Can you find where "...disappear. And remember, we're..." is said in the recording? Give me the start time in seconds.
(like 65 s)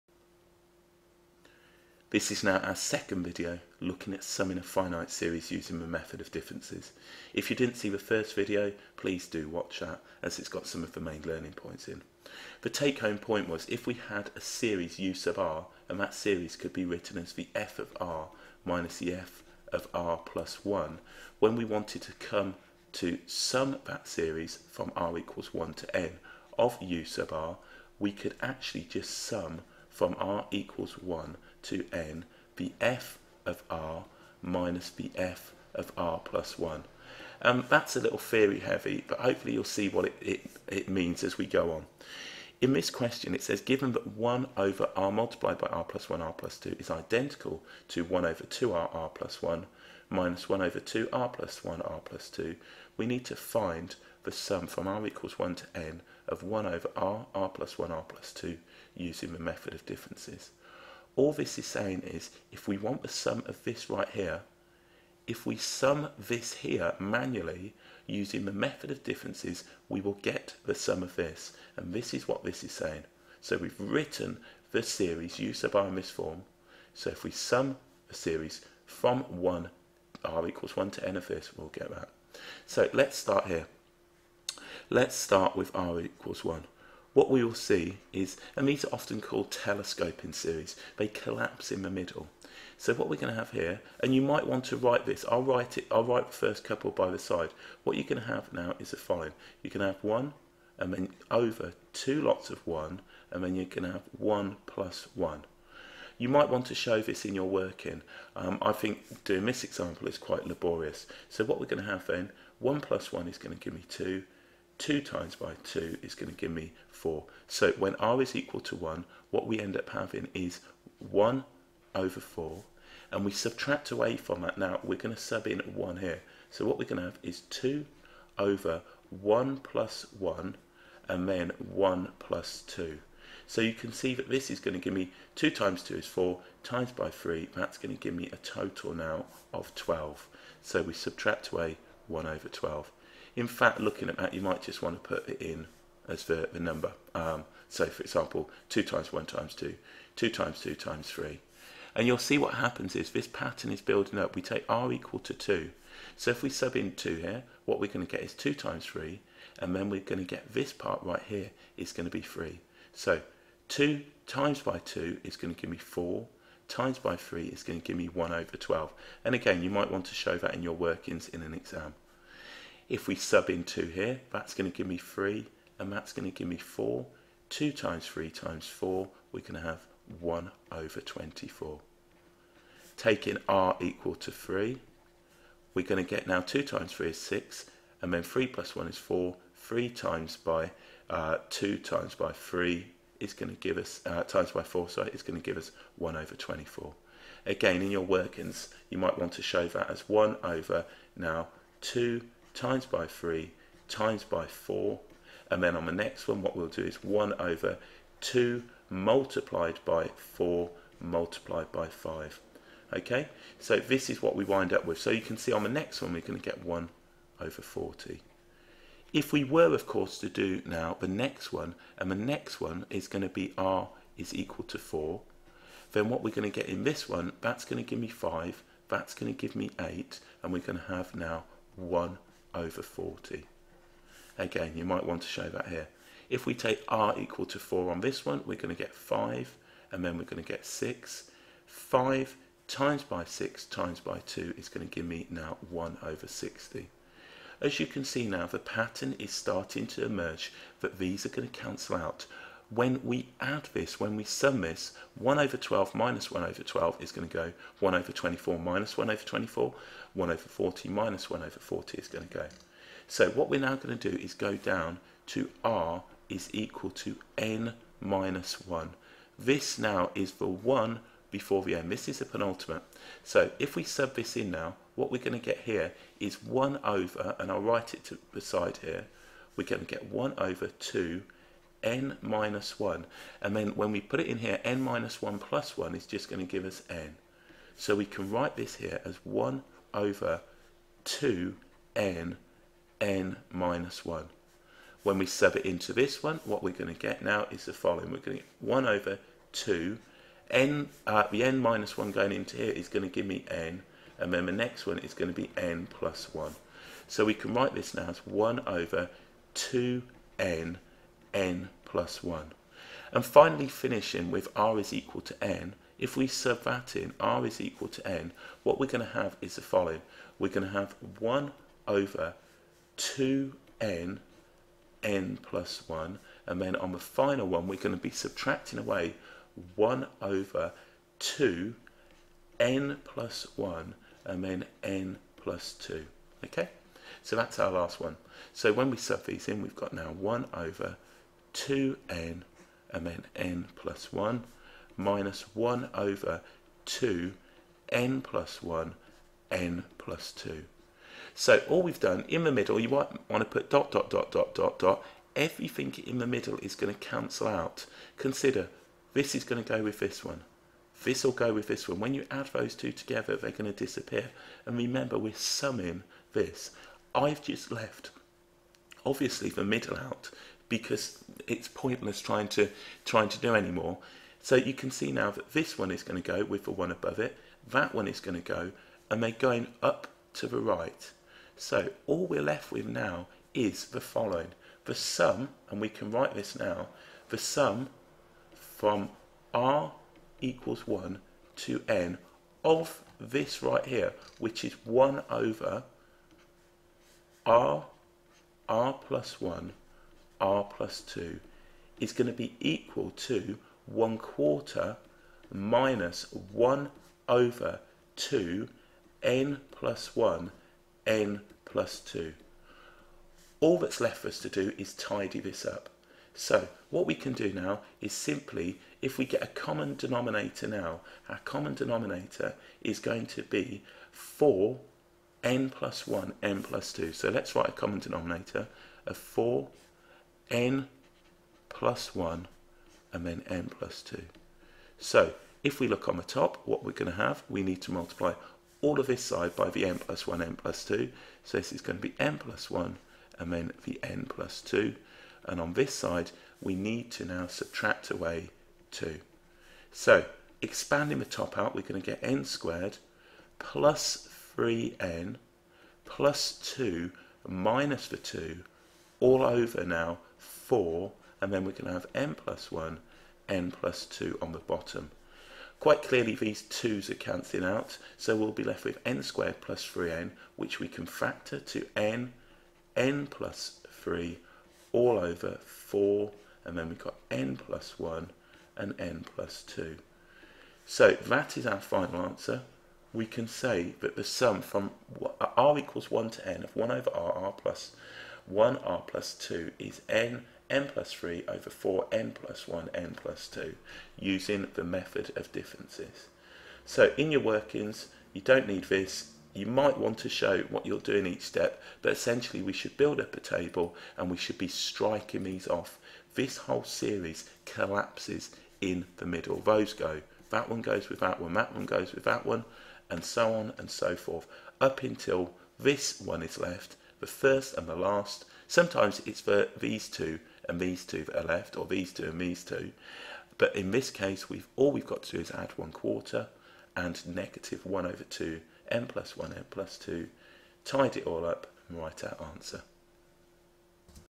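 363 s.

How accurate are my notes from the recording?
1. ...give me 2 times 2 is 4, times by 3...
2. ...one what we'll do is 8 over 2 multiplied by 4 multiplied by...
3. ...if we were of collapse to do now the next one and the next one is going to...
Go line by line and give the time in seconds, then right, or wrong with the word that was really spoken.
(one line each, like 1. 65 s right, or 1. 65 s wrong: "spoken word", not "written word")
1. 134 s right
2. 206 s wrong: "1", not "8"
3. 219 s wrong: "course", not "collapse".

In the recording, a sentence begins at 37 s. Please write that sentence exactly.
Um, that's a little theory heavy, but hopefully you'll see what it, it, it means as we go on.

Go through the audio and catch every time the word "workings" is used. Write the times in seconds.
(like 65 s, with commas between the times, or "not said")
107 s, 170 s, 198 s, 497 s.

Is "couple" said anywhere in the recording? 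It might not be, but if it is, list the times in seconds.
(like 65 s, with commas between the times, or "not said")
96 s.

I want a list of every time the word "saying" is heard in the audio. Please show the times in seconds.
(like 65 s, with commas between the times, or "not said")
61 s, 72 s.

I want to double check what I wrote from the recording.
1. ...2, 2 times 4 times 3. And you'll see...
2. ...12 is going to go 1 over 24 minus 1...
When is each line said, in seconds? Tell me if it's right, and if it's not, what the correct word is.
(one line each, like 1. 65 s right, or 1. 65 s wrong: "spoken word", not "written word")
1. 149 s wrong: "2", not "4"
2. 256 s right.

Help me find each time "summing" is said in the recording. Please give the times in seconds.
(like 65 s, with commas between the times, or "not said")
4 s, 365 s.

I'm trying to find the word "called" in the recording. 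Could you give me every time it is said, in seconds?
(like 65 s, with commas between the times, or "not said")
89 s.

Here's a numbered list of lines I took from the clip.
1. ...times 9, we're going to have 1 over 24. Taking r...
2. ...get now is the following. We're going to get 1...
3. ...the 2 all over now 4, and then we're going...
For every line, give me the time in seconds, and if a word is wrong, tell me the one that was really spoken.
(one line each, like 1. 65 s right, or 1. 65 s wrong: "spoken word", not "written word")
1. 178 s wrong: "4", not "9"
2. 296 s right
3. 458 s right.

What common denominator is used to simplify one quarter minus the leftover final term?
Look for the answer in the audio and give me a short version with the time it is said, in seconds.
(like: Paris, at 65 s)
4(n+1)(n+2), at 424 s.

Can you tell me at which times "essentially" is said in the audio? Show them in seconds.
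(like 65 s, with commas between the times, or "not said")
502 s.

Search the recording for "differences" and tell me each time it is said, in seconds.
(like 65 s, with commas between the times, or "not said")
6 s, 59 s, 69 s, 495 s.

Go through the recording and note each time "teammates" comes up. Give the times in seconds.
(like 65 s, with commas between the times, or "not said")
not said.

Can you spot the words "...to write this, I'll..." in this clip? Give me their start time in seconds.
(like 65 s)
94 s.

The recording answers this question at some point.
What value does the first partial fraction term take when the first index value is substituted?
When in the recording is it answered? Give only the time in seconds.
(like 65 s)
121 s.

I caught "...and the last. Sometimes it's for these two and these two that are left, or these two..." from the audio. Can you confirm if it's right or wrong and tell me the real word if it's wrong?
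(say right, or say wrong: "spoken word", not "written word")
right.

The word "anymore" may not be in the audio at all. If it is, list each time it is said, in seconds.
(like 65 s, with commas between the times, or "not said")
373 s.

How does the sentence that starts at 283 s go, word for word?
And then when we put it in here, n minus 1 plus 1 is just going to give us n.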